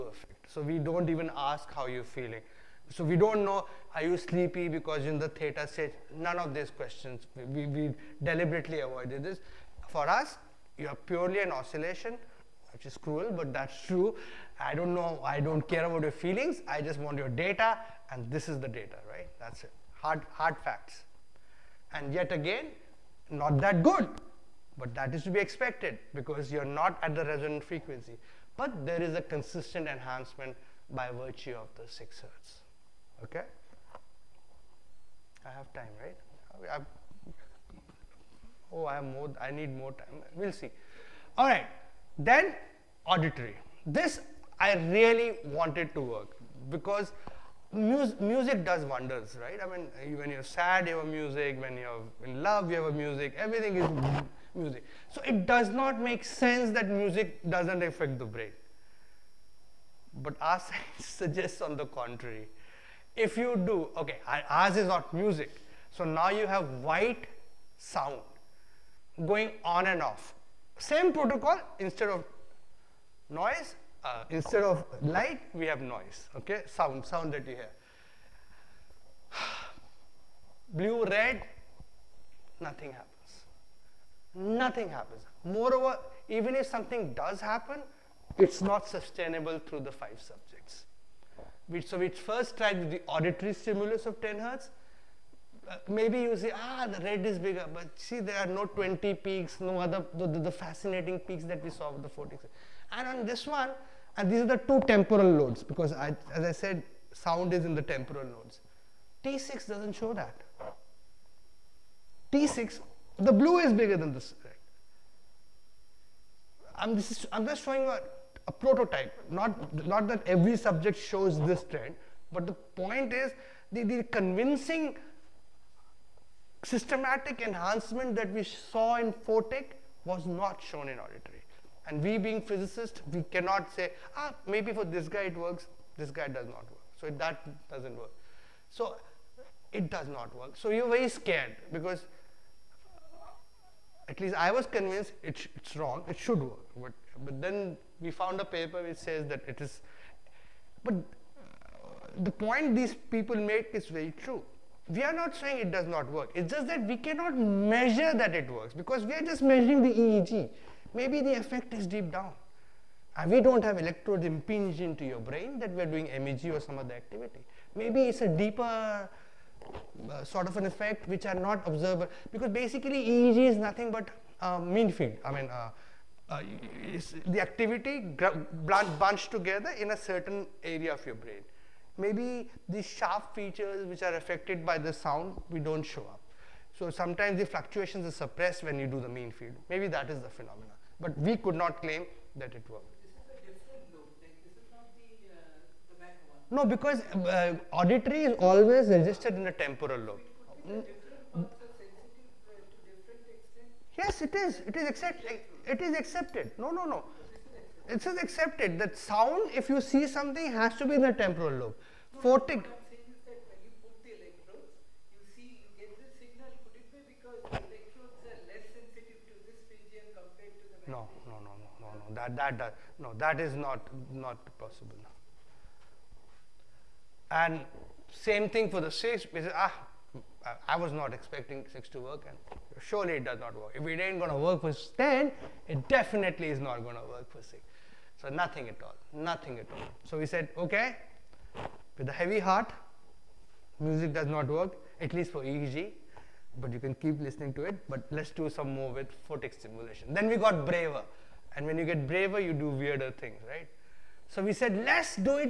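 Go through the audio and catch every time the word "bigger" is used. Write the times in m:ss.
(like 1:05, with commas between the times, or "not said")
1:37, 1:53.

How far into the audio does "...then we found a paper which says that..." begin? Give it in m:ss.
2:27.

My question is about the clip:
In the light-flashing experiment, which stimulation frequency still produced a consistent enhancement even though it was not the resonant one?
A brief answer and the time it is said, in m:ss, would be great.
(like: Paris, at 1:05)
6 hertz, at 0:31.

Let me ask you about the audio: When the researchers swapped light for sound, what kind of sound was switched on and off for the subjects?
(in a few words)
White sound.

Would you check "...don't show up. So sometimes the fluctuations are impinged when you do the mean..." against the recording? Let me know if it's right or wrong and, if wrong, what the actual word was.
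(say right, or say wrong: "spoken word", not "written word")
wrong: "suppressed", not "impinged".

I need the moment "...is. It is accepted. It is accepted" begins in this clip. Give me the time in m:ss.
3:24.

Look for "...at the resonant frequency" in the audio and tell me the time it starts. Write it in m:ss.
0:27.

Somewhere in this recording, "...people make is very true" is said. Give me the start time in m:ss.
2:32.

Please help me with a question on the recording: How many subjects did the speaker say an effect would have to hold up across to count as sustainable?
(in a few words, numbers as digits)
5.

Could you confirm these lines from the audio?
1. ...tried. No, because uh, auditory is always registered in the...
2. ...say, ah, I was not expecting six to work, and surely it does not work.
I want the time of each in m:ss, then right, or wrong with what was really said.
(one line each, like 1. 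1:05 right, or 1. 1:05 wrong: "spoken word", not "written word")
1. 3:12 wrong: "worked", not "tried"
2. 3:49 right.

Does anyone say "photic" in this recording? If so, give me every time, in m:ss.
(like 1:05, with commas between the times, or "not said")
1:42, 2:09, 3:32, 4:09.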